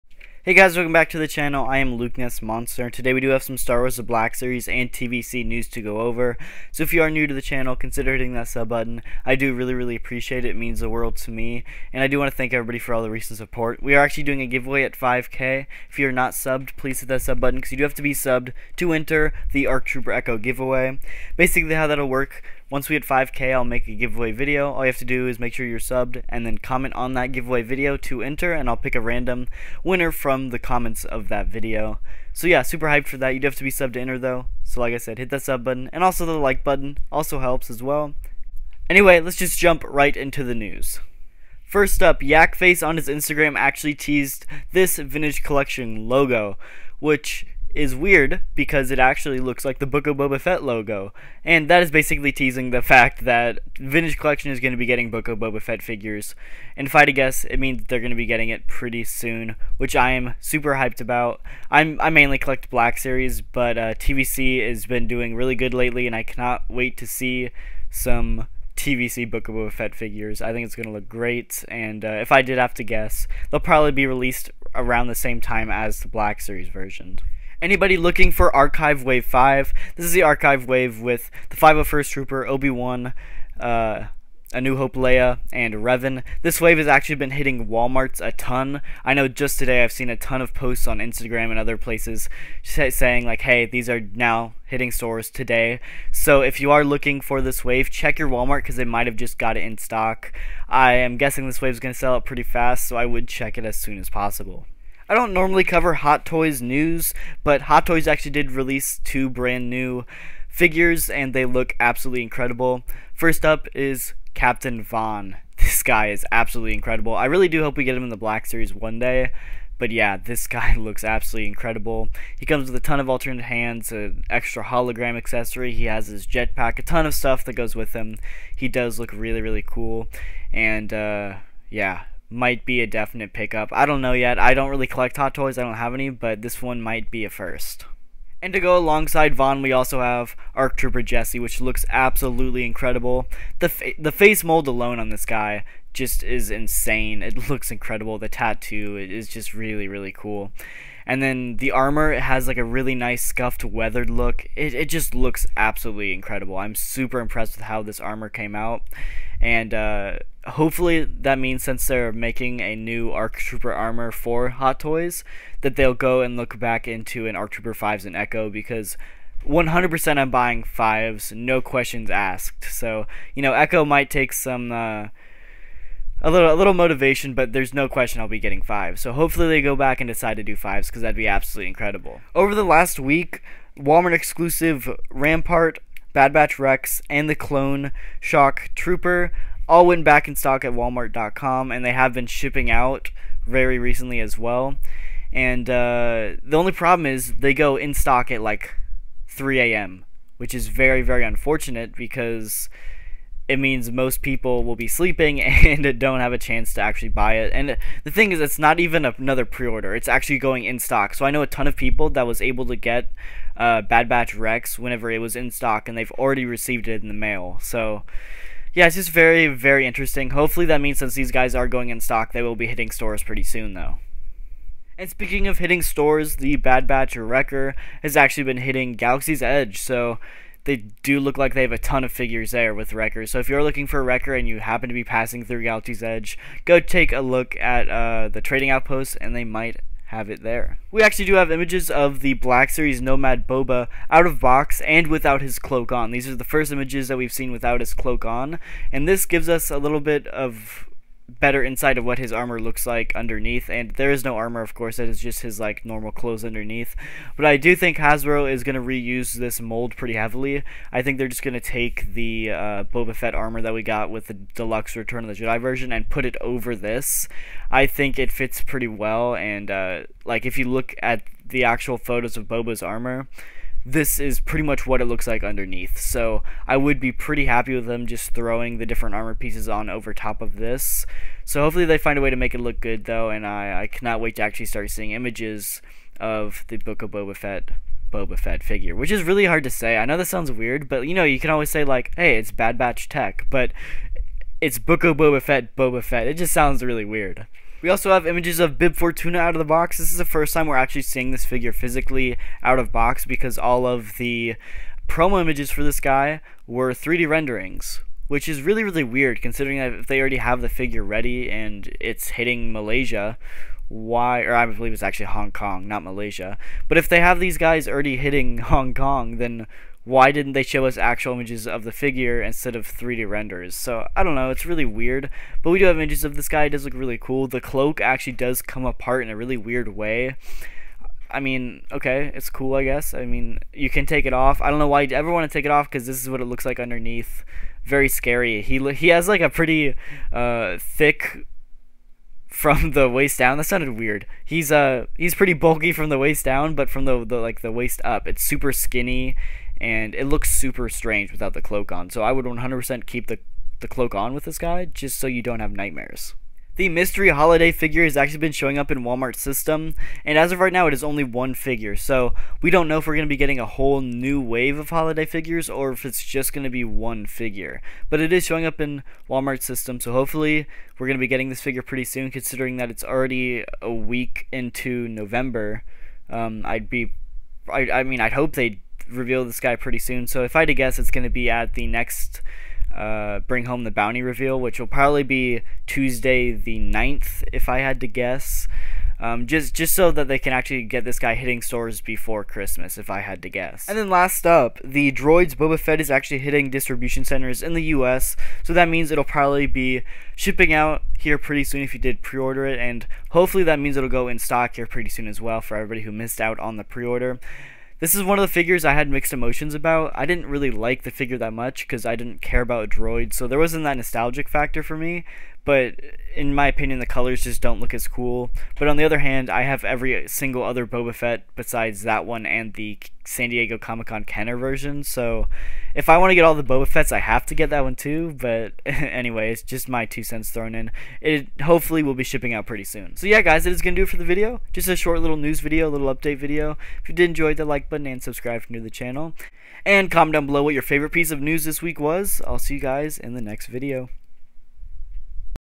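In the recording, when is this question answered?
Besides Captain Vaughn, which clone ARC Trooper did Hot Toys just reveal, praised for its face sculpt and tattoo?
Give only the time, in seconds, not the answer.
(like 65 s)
140 s.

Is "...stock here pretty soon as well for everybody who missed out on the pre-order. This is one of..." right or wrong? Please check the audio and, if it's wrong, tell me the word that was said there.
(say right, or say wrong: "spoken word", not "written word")
right.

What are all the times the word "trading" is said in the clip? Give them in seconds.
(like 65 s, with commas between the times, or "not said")
238 s.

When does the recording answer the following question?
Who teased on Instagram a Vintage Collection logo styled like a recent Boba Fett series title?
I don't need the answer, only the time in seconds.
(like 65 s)
42 s.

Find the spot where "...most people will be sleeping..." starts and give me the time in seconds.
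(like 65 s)
203 s.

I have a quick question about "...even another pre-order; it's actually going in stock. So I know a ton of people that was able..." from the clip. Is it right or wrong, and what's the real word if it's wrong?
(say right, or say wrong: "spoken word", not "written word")
right.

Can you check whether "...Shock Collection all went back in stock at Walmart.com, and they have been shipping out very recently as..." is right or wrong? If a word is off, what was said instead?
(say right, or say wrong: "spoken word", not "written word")
wrong: "Trooper", not "Collection".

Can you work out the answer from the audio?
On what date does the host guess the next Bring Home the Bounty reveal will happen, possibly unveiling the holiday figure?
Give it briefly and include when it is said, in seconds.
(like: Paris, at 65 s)
Tuesday the 9th, at 385 s.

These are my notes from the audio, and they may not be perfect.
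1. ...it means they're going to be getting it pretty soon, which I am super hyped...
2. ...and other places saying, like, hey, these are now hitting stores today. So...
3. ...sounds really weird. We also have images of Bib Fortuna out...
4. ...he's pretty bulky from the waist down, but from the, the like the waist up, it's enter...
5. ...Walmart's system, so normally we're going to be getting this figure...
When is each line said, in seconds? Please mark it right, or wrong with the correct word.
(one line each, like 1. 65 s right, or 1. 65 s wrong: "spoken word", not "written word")
1. 57 s right
2. 91 s right
3. 296 s right
4. 345 s wrong: "super", not "enter"
5. 369 s wrong: "hopefully", not "normally".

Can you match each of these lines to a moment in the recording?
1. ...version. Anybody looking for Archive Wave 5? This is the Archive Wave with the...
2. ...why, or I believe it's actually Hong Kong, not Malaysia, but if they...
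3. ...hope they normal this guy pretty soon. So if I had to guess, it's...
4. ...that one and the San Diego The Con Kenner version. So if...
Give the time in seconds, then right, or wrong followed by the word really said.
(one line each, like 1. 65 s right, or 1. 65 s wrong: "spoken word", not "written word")
1. 76 s right
2. 313 s right
3. 378 s wrong: "reveal", not "normal"
4. 422 s wrong: "Comic", not "The".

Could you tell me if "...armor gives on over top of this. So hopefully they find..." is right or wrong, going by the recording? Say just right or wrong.
wrong.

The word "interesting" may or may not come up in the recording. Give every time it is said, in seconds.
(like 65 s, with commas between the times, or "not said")
219 s.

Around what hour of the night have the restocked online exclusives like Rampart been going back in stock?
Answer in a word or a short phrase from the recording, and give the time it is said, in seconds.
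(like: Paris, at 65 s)
3 a.m., at 199 s.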